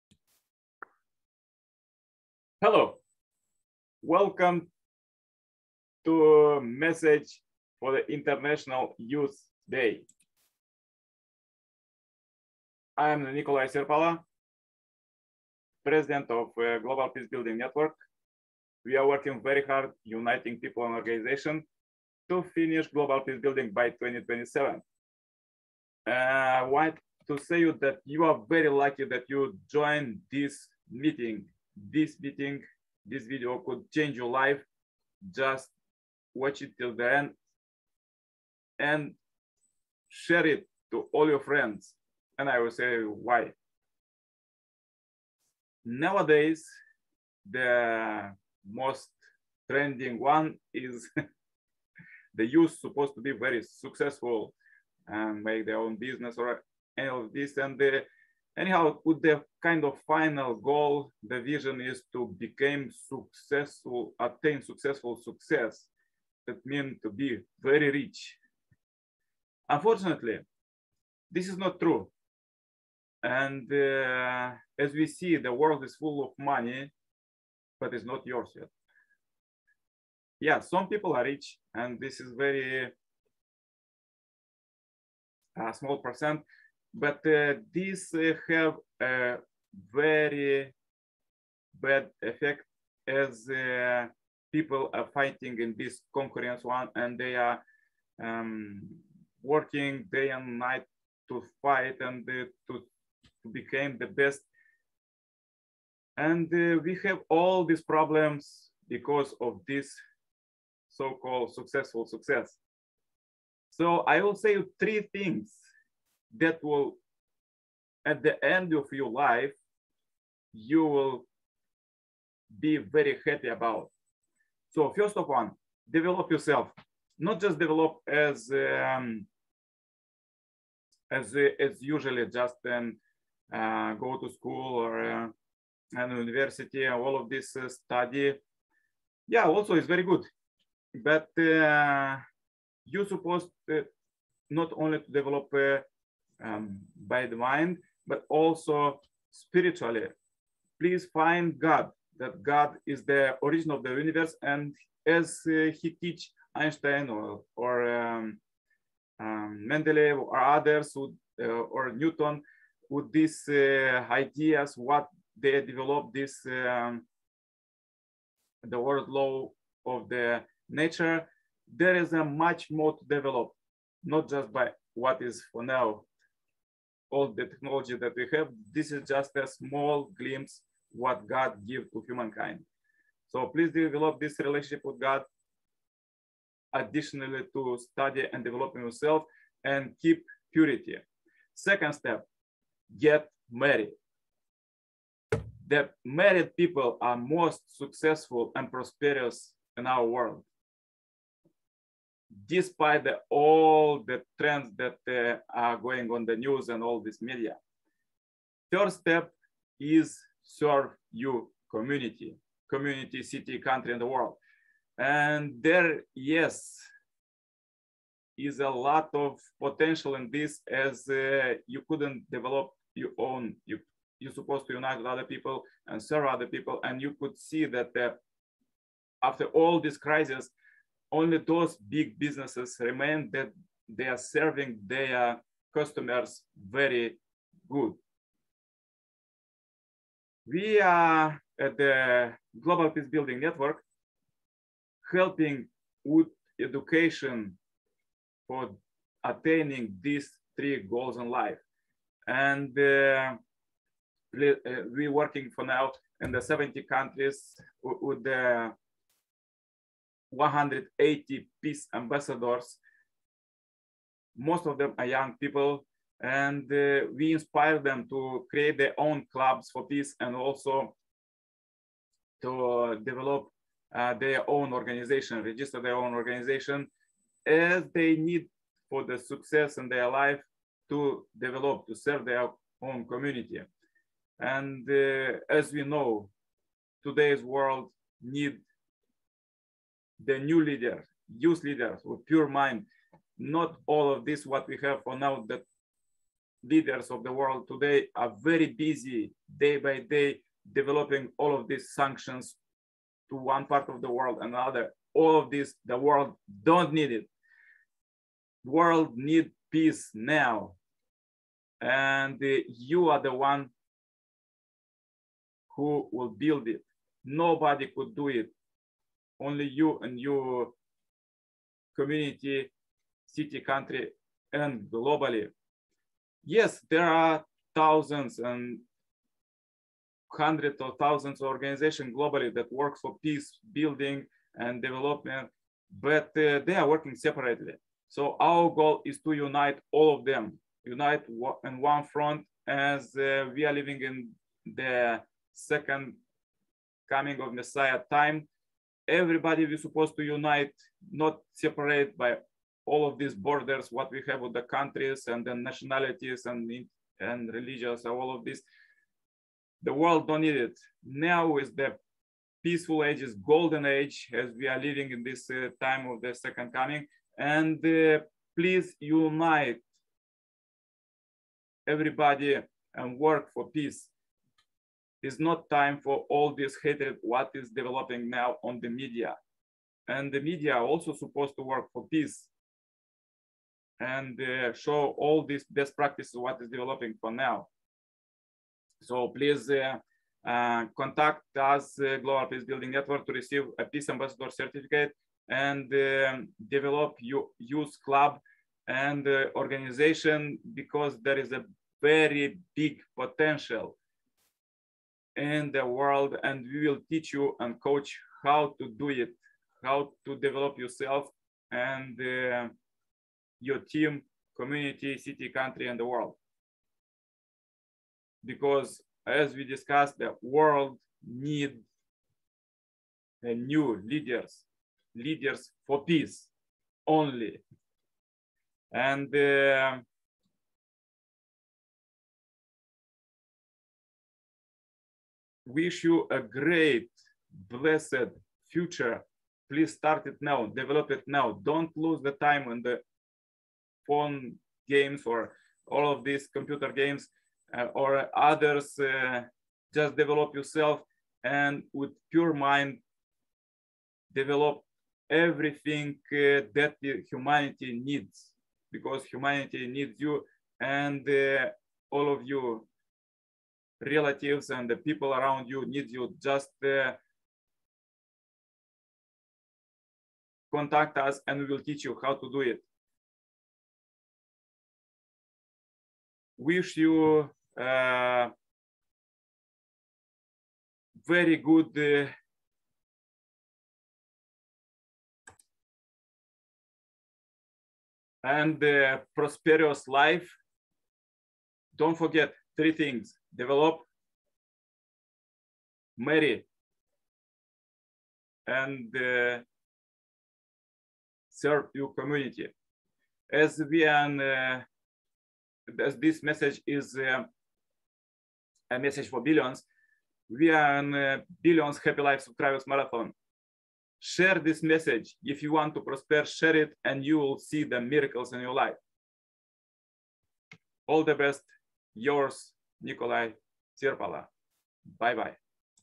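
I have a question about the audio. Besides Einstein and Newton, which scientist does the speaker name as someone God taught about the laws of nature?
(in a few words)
Mendeleev.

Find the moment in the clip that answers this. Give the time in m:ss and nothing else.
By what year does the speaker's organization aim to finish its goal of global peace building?
0:23.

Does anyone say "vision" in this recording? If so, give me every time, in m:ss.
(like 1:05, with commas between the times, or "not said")
1:01.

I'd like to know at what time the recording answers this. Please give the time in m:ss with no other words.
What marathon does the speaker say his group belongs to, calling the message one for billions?
8:31.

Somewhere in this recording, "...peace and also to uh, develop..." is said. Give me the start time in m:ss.
4:29.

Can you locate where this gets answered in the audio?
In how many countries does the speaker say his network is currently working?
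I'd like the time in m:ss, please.
4:16.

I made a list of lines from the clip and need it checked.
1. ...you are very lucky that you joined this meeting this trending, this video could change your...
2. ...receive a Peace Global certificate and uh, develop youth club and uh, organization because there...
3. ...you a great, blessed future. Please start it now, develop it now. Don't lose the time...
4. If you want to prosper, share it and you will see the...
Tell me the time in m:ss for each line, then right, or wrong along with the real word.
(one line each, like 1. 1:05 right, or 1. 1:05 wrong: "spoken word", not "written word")
1. 0:28 wrong: "meeting", not "trending"
2. 6:33 wrong: "Ambassador", not "Global"
3. 7:16 right
4. 8:35 right.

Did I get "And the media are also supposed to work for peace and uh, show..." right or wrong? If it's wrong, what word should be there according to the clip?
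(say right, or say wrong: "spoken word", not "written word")
right.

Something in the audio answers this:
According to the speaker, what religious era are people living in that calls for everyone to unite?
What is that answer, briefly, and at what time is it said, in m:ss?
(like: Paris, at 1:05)
second coming of Messiah, at 5:45.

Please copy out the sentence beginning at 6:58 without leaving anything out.
Because as we discussed, the world need uh, new leaders, leaders for peace only.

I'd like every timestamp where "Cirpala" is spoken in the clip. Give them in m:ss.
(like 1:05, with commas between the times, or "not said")
0:13, 8:43.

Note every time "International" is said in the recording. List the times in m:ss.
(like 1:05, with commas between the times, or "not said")
0:08.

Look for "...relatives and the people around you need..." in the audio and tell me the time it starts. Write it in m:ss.
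7:44.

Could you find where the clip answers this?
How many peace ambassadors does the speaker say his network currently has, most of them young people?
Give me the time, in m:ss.
4:20.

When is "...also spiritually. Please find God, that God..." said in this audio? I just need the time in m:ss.
2:28.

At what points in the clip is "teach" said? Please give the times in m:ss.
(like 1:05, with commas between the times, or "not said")
2:36, 6:47, 7:51.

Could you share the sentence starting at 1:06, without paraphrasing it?
That means to be very rich.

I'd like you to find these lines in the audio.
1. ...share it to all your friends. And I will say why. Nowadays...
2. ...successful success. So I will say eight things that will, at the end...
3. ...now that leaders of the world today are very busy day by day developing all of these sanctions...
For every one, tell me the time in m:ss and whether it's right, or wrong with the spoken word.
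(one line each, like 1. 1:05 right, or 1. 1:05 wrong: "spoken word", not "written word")
1. 0:40 right
2. 1:51 wrong: "three", not "eight"
3. 4:55 right.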